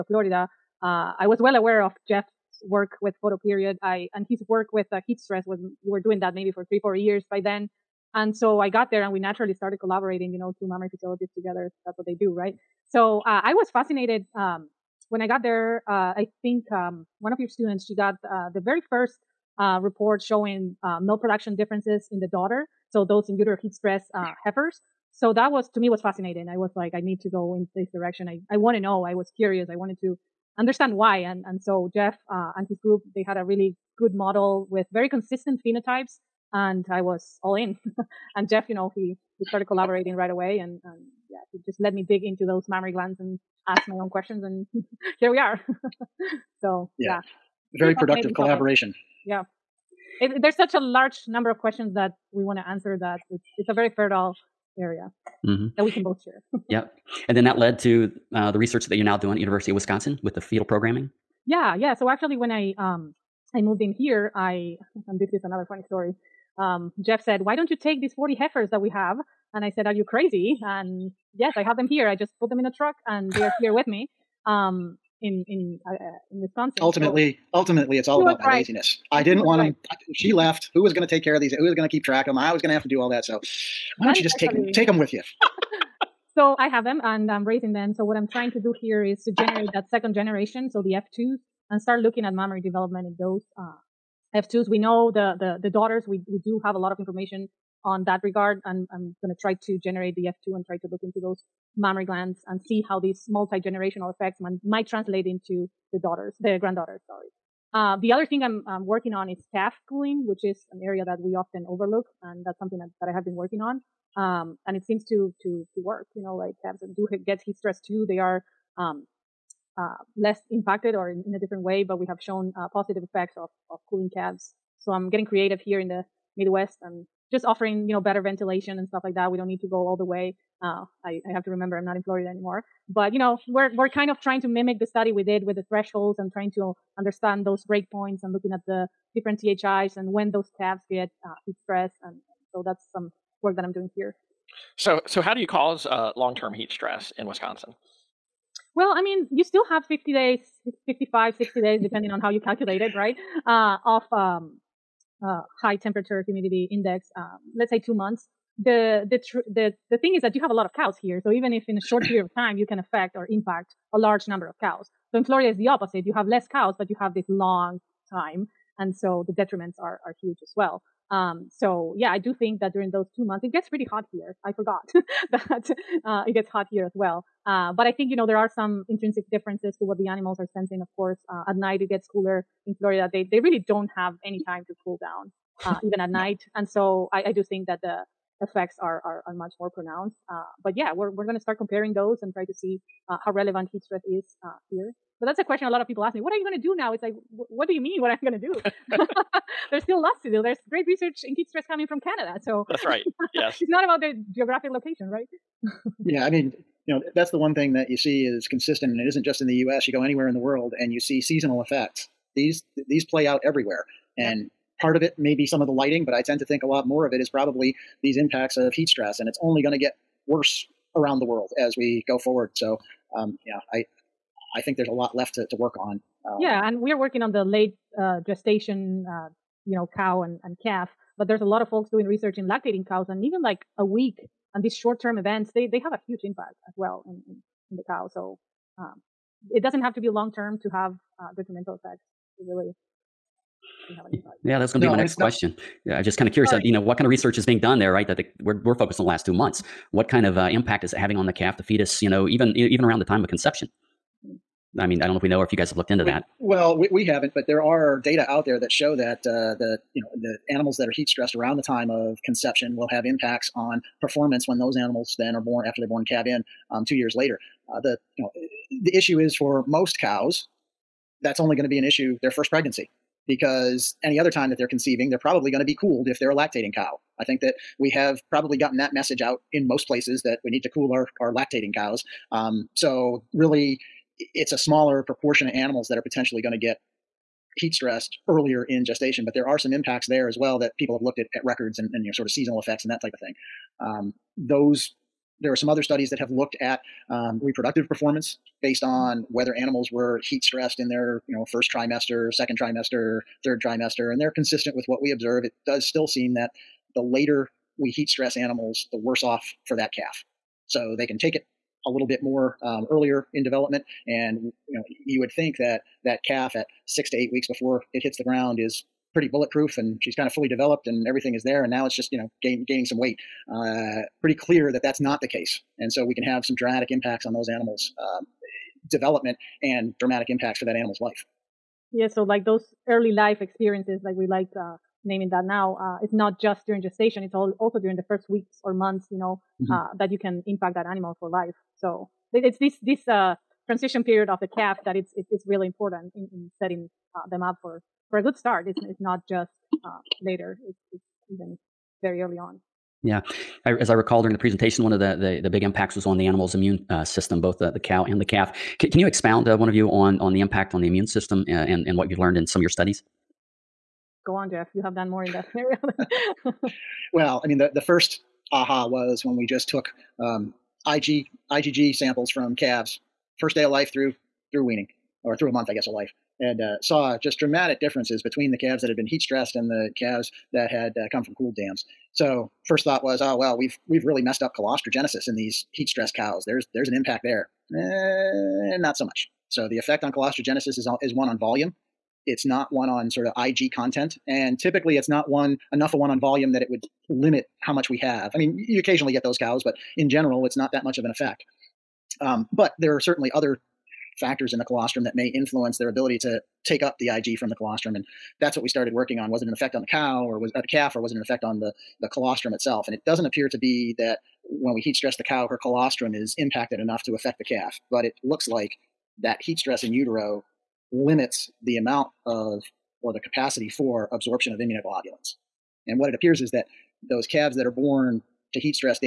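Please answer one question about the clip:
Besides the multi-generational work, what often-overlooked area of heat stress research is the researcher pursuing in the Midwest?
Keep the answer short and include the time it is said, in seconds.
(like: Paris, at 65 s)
calf cooling, at 109 s.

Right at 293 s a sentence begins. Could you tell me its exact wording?
Um, those there are some other studies that have looked at um, reproductive performance based mm-hmm.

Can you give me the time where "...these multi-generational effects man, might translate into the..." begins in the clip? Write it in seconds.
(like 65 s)
102 s.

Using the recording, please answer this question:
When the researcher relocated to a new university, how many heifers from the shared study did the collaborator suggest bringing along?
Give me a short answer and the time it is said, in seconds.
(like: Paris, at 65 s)
40, at 68 s.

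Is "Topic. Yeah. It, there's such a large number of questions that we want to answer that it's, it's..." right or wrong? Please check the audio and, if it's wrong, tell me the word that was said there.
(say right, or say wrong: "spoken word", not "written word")
right.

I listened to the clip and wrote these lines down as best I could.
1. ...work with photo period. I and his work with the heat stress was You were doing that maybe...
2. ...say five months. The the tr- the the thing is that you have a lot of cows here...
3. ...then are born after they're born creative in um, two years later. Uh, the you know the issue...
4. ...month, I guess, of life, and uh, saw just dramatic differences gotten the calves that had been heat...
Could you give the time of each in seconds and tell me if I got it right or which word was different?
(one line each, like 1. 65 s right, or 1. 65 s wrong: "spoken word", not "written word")
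1. 2 s right
2. 157 s wrong: "two", not "five"
3. 265 s wrong: "calve", not "creative"
4. 375 s wrong: "between", not "gotten".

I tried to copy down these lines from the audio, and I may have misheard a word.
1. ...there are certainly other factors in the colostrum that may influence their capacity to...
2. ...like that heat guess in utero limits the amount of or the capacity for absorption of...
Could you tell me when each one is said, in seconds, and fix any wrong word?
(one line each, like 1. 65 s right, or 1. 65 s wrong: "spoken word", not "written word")
1. 402 s wrong: "ability", not "capacity"
2. 418 s wrong: "stress", not "guess".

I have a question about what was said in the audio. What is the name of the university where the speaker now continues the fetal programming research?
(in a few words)
University of Wisconsin.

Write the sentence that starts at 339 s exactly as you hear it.
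uh, that you can impact that animal for life.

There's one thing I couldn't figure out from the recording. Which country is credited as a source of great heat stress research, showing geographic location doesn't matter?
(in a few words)
Canada.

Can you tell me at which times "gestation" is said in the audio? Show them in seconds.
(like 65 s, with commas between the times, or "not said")
228 s, 288 s, 336 s.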